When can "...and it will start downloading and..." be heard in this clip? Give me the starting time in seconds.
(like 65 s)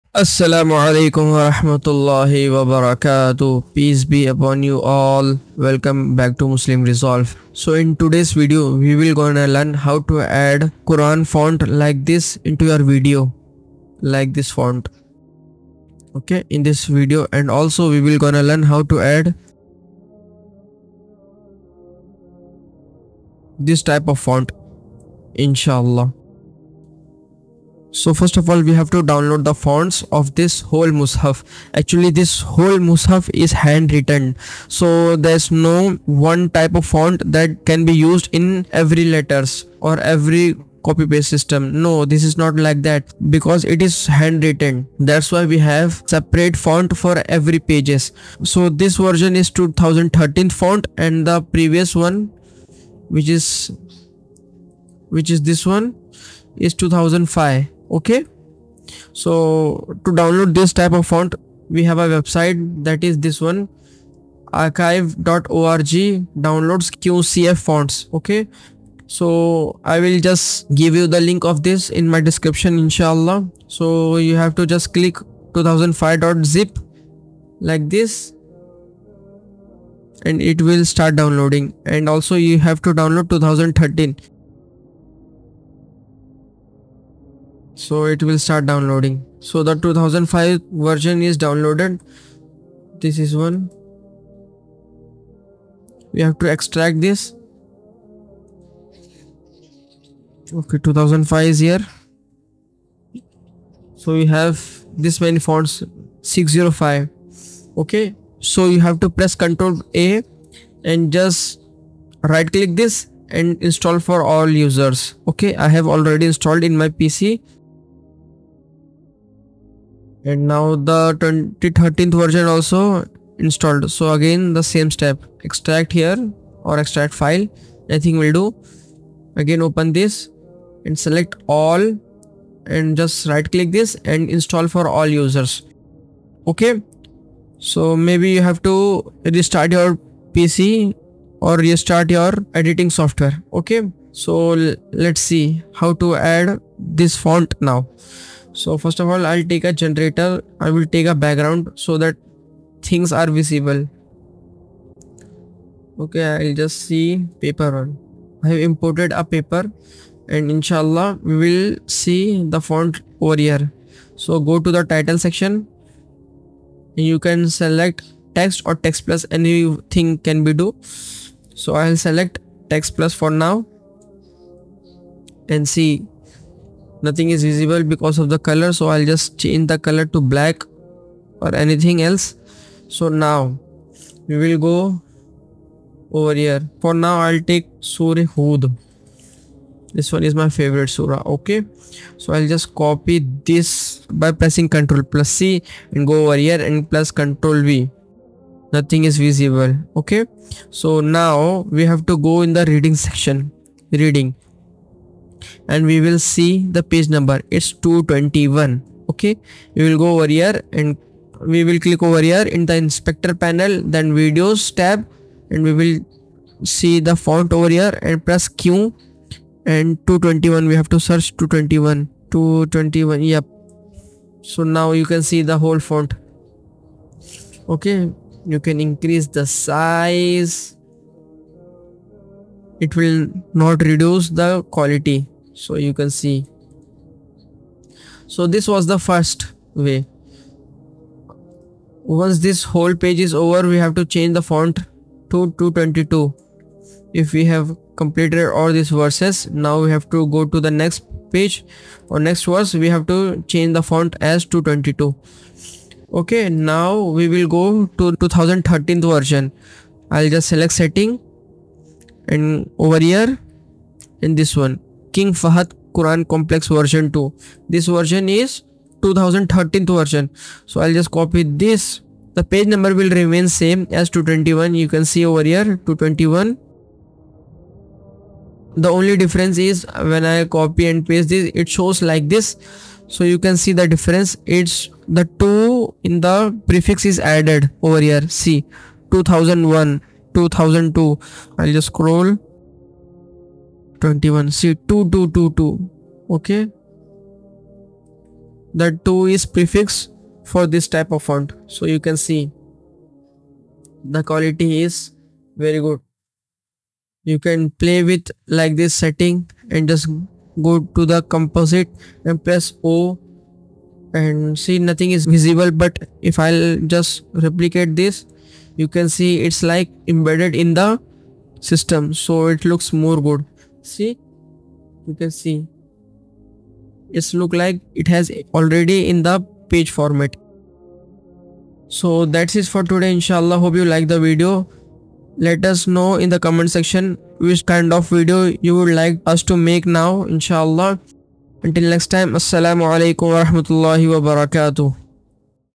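80 s.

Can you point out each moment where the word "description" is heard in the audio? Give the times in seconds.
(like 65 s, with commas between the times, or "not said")
72 s.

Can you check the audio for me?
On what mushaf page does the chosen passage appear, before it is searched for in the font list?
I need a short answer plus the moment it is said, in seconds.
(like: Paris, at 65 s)
221, at 207 s.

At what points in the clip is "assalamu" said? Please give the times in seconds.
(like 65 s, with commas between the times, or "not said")
0 s, 342 s.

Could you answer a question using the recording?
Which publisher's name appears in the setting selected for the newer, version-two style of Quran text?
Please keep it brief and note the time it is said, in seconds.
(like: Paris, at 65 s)
King Fahad Quran Complex, at 265 s.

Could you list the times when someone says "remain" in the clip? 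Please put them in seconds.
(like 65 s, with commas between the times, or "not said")
273 s.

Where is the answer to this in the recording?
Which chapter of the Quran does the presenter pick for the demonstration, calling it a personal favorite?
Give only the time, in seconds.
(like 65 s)
187 s.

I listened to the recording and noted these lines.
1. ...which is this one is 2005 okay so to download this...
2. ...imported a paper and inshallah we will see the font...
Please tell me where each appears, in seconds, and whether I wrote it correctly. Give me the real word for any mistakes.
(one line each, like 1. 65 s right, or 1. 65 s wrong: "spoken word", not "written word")
1. 55 s right
2. 158 s right.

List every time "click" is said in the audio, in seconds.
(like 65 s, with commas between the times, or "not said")
74 s, 112 s, 133 s, 211 s.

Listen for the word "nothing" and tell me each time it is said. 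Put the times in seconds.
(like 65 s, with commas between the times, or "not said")
177 s, 198 s, 314 s.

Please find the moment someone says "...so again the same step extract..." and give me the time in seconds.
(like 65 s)
123 s.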